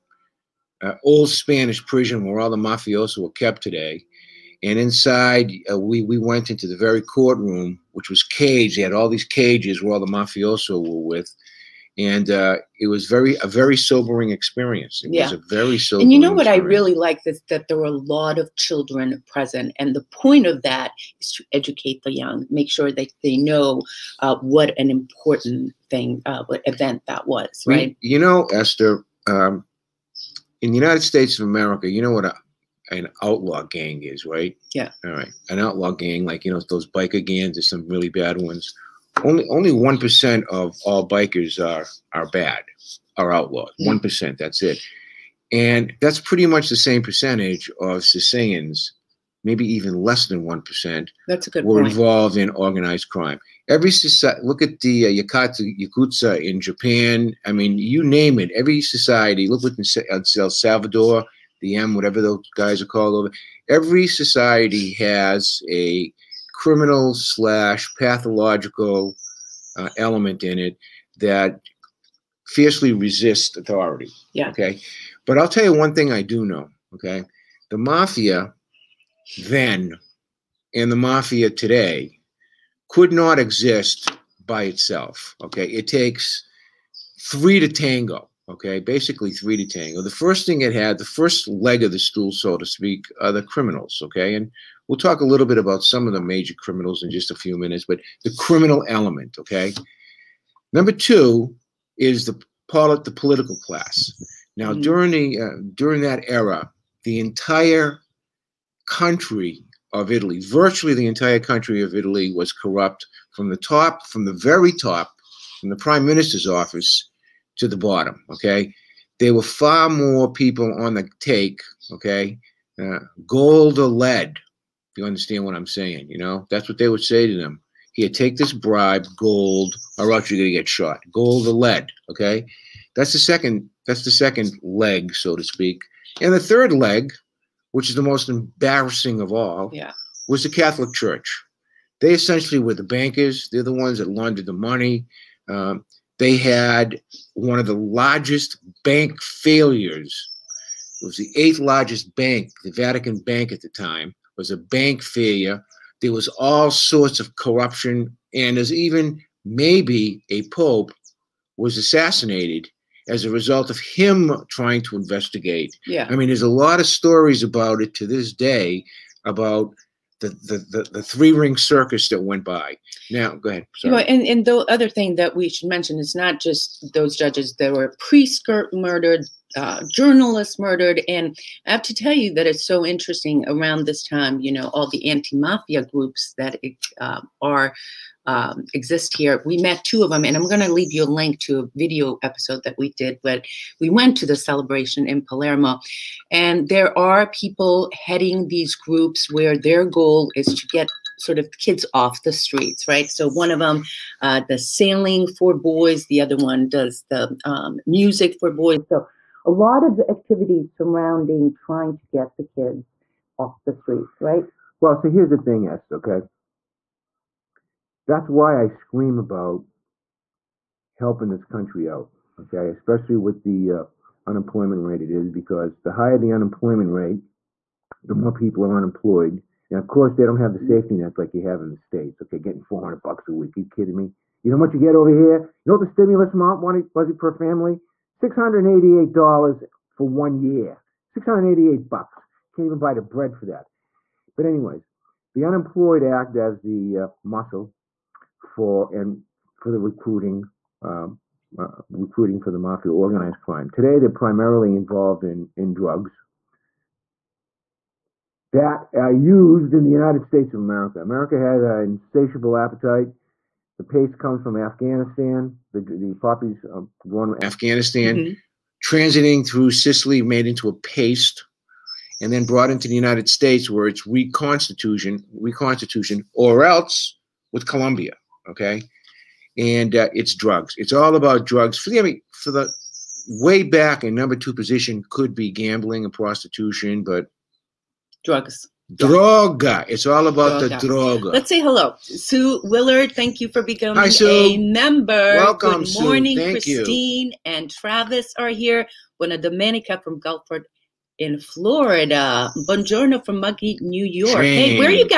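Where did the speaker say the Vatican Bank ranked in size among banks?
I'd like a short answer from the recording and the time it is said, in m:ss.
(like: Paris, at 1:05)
Eighth largest, at 2:31.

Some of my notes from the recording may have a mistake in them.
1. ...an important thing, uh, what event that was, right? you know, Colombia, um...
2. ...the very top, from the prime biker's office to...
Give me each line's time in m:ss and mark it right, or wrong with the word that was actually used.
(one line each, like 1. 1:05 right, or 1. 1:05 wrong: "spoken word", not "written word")
1. 0:24 wrong: "Eszter", not "Colombia"
2. 1:54 wrong: "minister", not "biker".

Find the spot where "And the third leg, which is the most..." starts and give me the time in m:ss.
2:16.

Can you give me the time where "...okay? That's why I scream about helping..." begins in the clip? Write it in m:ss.
3:35.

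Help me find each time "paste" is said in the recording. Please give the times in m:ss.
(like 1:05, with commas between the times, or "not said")
4:23, 4:30.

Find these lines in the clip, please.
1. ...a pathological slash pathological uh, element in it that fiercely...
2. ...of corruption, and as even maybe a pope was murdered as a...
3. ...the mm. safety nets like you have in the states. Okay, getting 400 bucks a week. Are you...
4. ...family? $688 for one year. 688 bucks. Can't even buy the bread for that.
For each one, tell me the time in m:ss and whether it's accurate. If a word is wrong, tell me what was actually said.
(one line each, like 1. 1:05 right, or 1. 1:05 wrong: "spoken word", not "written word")
1. 1:05 wrong: "criminal", not "pathological"
2. 2:37 wrong: "assassinated", not "murdered"
3. 3:50 right
4. 3:57 right.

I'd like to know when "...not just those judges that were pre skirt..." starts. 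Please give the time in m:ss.
2:56.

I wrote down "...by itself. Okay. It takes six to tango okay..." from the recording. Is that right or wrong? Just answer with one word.
wrong.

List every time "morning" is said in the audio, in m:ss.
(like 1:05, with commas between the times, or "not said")
4:56.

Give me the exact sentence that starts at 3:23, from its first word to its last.
So one of them uh, does sailing for boys, the other one does the um, music for boys.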